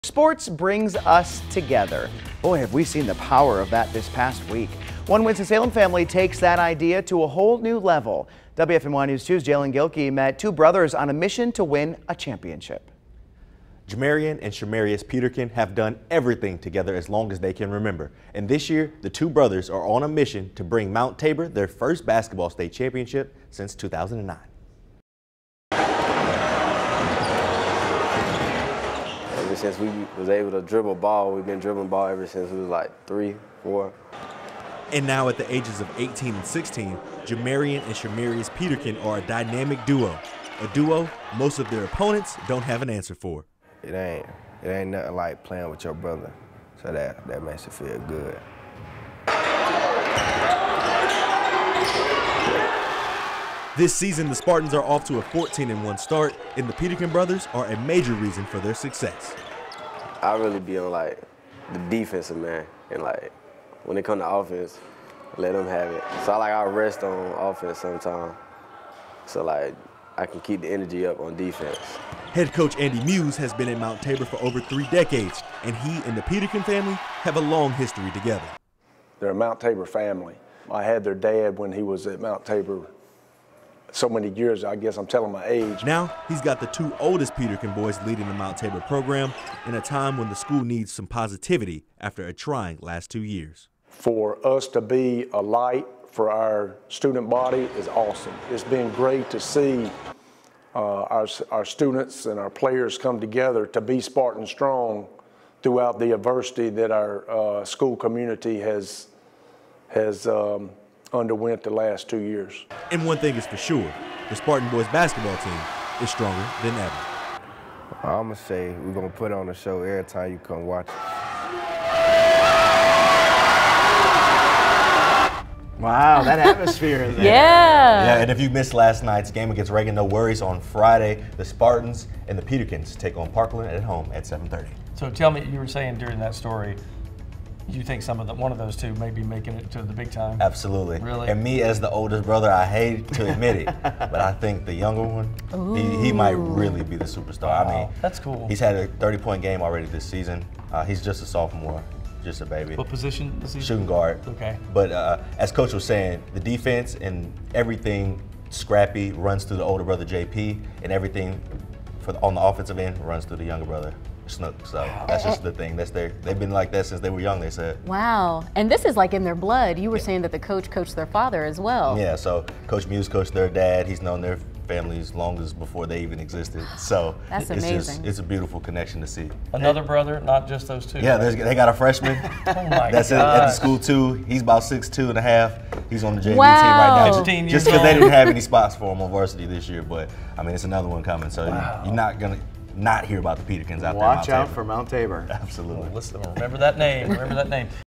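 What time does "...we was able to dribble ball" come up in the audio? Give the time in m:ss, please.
0:29.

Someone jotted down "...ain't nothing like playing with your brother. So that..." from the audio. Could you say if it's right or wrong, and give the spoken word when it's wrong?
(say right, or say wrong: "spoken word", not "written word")
right.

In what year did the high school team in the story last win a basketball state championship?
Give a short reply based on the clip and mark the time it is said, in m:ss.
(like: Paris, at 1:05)
2009, at 0:23.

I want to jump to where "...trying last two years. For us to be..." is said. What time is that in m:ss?
1:32.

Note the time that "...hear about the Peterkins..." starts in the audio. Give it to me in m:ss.
3:13.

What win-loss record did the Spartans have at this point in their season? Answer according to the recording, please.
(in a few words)
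14-1.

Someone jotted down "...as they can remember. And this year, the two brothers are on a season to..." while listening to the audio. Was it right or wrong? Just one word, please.
wrong.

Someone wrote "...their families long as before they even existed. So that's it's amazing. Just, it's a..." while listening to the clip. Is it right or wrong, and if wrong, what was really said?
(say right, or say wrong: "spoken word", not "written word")
right.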